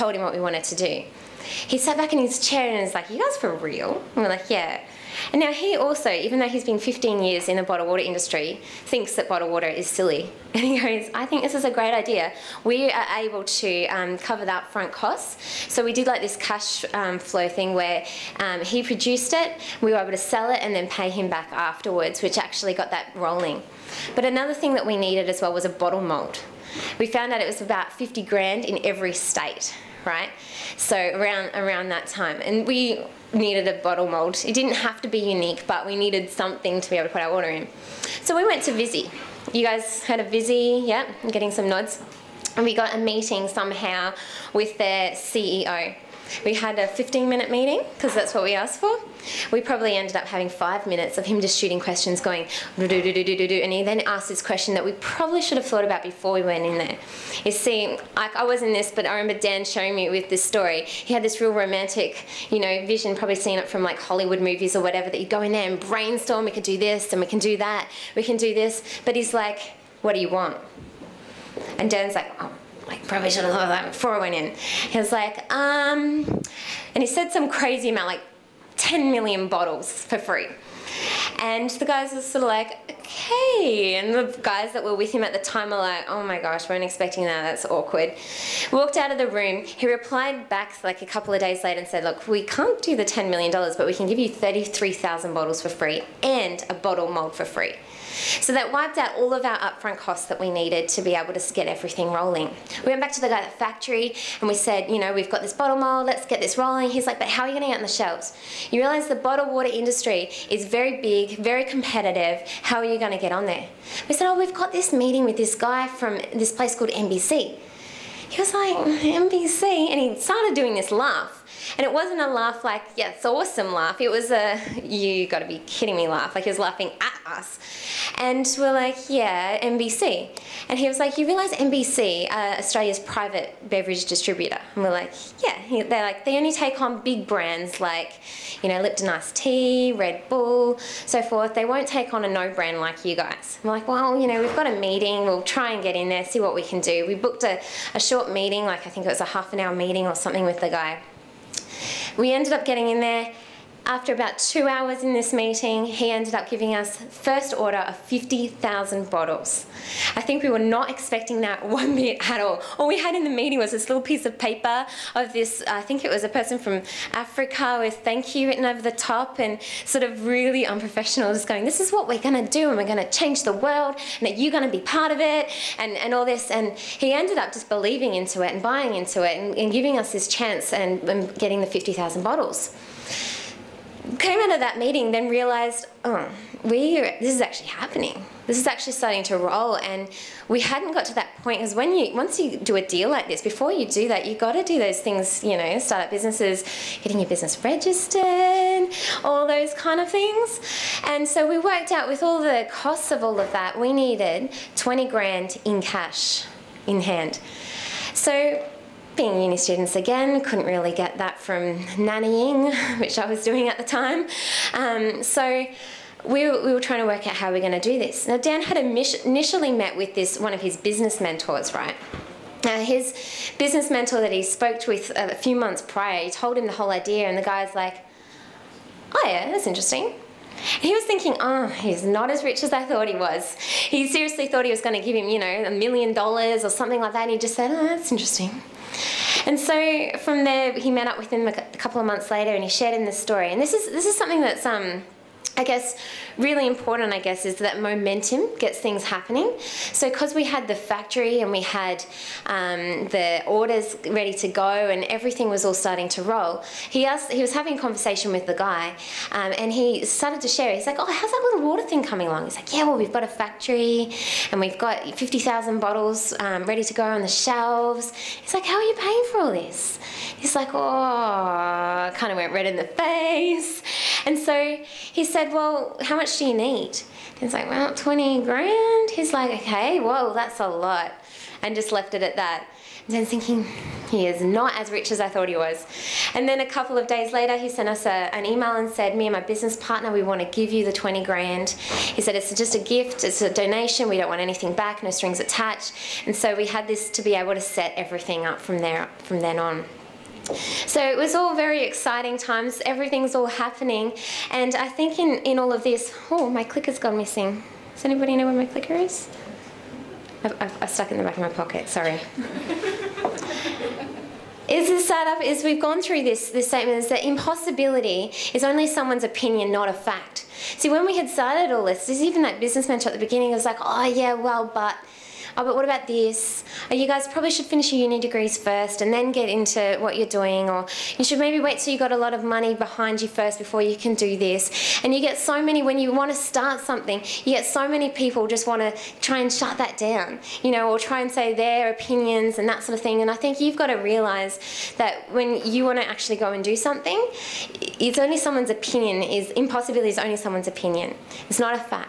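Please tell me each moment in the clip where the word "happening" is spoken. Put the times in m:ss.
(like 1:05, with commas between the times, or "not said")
3:07, 4:09, 5:03.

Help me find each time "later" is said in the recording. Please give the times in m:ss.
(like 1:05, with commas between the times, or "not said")
1:31, 4:02, 4:47.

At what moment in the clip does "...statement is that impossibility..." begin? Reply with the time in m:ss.
5:16.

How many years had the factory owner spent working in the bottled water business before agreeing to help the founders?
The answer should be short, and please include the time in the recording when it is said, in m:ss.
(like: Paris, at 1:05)
15, at 0:06.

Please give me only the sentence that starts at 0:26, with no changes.
We found out it was about 50 grand in every state right?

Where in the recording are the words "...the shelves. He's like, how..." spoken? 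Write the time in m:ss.
4:27.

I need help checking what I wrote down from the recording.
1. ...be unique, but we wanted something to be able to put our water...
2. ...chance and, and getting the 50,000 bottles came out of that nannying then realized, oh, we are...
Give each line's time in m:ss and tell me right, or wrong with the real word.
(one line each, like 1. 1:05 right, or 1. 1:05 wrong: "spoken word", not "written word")
1. 0:35 wrong: "needed", not "wanted"
2. 3:00 wrong: "meeting", not "nannying".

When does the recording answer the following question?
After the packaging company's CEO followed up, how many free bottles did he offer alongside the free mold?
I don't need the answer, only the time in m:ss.
1:34.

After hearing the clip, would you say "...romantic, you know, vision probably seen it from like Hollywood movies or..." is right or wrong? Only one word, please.
right.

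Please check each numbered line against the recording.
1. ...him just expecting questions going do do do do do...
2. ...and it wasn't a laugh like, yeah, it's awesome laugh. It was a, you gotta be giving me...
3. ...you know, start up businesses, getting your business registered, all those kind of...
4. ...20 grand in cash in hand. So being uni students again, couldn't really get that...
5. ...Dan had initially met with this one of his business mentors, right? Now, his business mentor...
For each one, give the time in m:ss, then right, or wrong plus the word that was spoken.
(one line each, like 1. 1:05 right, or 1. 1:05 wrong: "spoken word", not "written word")
1. 0:51 wrong: "shooting", not "expecting"
2. 2:01 wrong: "kidding", not "giving"
3. 3:15 right
4. 3:24 right
5. 3:38 right.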